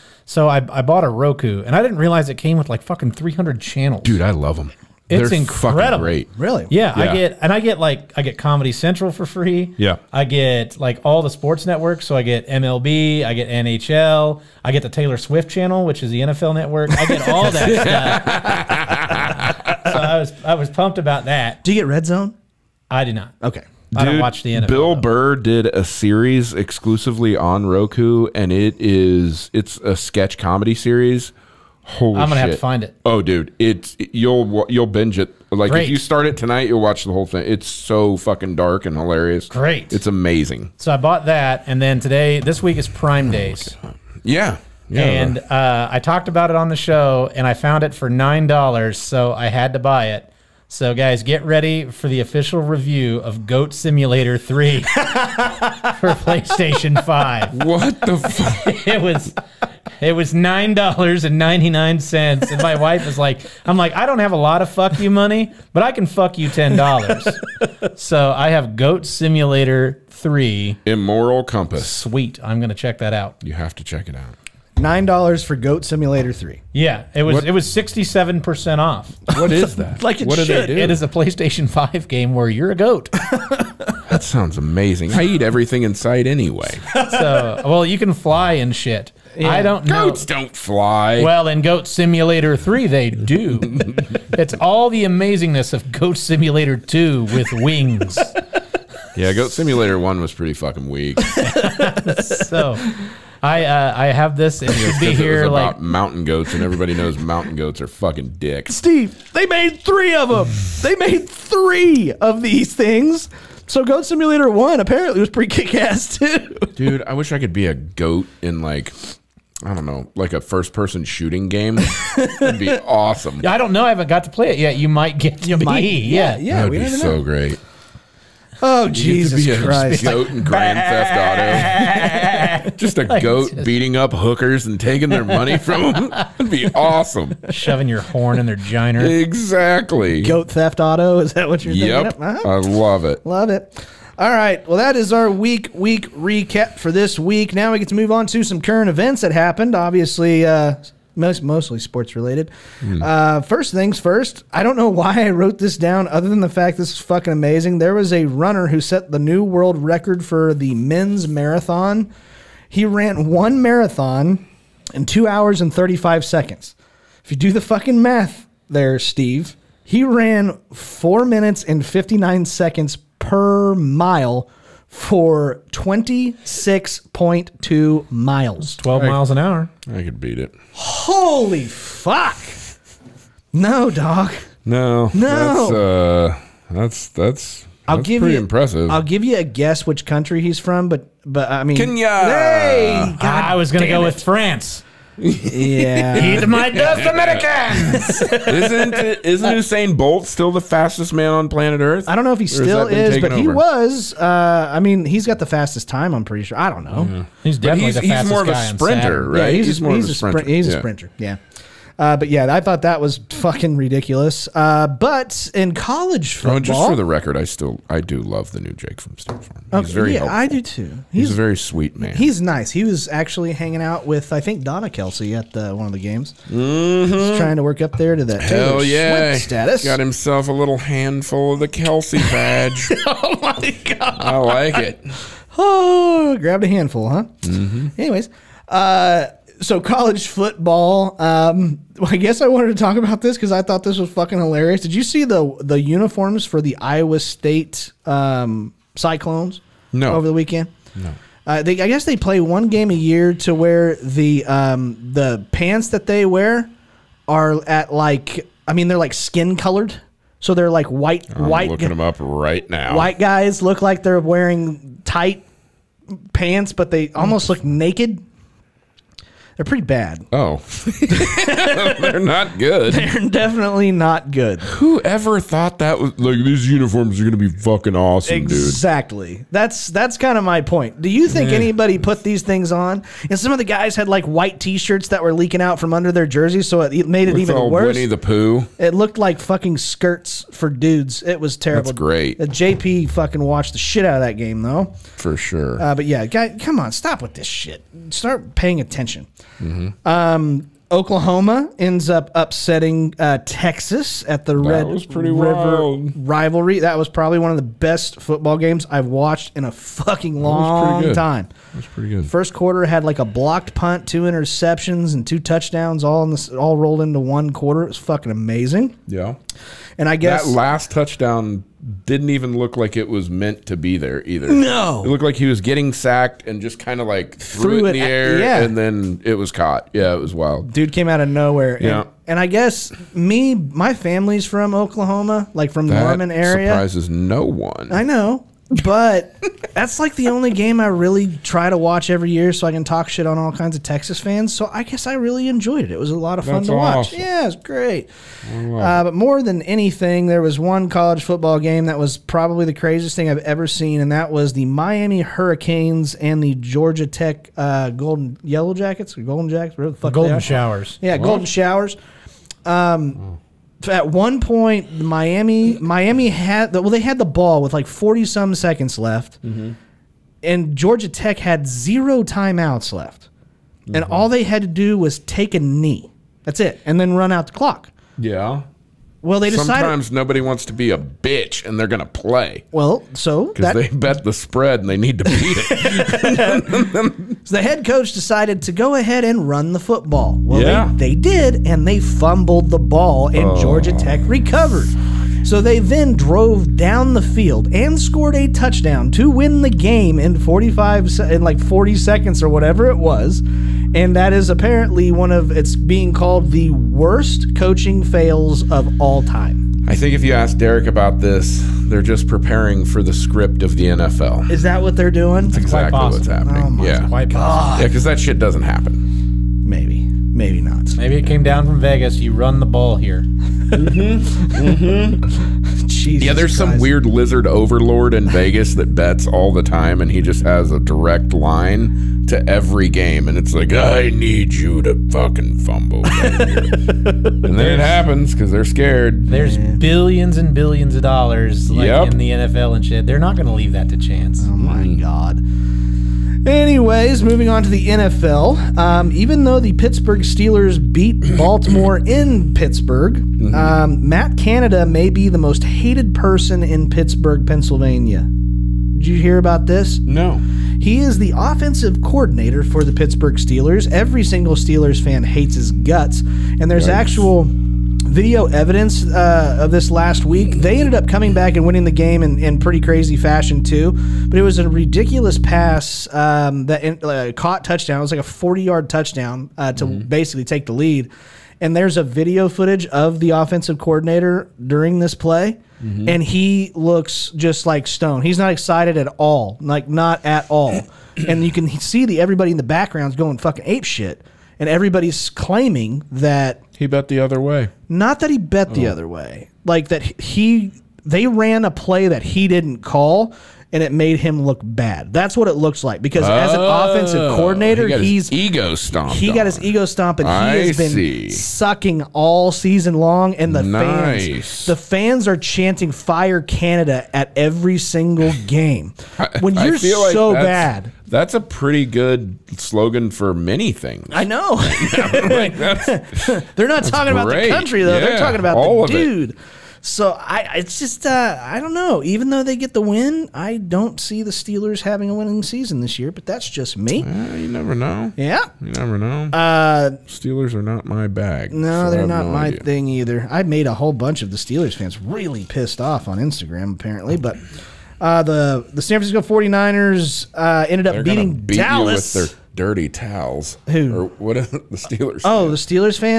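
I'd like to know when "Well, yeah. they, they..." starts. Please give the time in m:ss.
6:30.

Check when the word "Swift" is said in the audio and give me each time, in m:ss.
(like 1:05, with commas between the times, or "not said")
0:15, 3:49.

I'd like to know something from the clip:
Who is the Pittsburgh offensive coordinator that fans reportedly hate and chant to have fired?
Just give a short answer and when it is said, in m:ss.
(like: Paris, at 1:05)
Matt Canada, at 7:34.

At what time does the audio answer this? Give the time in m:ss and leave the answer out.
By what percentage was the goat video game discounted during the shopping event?
1:17.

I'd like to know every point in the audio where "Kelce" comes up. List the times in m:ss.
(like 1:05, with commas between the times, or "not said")
3:44, 3:51.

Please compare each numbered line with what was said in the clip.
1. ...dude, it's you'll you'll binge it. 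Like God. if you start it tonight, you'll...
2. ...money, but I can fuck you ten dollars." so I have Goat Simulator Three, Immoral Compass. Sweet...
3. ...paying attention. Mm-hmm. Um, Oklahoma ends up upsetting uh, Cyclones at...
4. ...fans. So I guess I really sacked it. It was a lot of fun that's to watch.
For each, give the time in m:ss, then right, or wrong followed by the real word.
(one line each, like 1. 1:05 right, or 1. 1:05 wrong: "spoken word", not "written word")
1. 0:33 wrong: "Great", not "God"
2. 1:05 right
3. 4:58 wrong: "Texas", not "Cyclones"
4. 5:44 wrong: "enjoyed", not "sacked".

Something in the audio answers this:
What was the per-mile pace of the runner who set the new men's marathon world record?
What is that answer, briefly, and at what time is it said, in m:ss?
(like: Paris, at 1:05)
4:59 per mile, at 2:50.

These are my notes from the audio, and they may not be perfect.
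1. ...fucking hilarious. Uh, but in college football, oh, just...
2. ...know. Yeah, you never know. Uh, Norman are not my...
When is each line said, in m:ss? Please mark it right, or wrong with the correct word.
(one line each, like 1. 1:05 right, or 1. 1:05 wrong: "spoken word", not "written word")
1. 3:33 wrong: "ridiculous", not "hilarious"
2. 8:57 wrong: "Steelers", not "Norman".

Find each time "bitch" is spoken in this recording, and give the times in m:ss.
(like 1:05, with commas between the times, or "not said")
6:20.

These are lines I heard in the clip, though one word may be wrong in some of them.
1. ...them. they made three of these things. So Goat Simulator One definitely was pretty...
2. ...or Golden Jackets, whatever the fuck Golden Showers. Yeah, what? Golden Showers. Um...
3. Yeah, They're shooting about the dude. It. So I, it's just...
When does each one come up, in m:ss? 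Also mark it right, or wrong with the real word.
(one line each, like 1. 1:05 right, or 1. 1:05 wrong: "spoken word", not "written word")
1. 1:50 wrong: "apparently", not "definitely"
2. 5:59 right
3. 8:47 wrong: "talking", not "shooting".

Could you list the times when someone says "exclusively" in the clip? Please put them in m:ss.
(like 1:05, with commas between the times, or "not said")
0:26.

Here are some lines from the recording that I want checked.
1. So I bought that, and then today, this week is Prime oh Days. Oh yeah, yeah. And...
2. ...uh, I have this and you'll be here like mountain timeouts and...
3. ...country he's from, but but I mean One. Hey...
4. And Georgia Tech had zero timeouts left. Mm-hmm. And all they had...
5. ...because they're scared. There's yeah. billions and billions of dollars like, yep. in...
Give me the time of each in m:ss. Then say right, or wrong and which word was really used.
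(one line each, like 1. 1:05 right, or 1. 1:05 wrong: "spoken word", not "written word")
1. 0:40 right
2. 1:43 wrong: "goats", not "timeouts"
3. 3:10 wrong: "Kenya", not "One"
4. 6:10 right
5. 7:18 right.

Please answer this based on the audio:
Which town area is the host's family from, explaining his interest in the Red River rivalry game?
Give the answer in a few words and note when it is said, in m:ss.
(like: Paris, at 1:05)
Norman, at 5:36.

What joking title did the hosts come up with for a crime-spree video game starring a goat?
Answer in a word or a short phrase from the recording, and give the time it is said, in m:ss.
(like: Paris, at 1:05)
Goat Theft Auto, at 2:20.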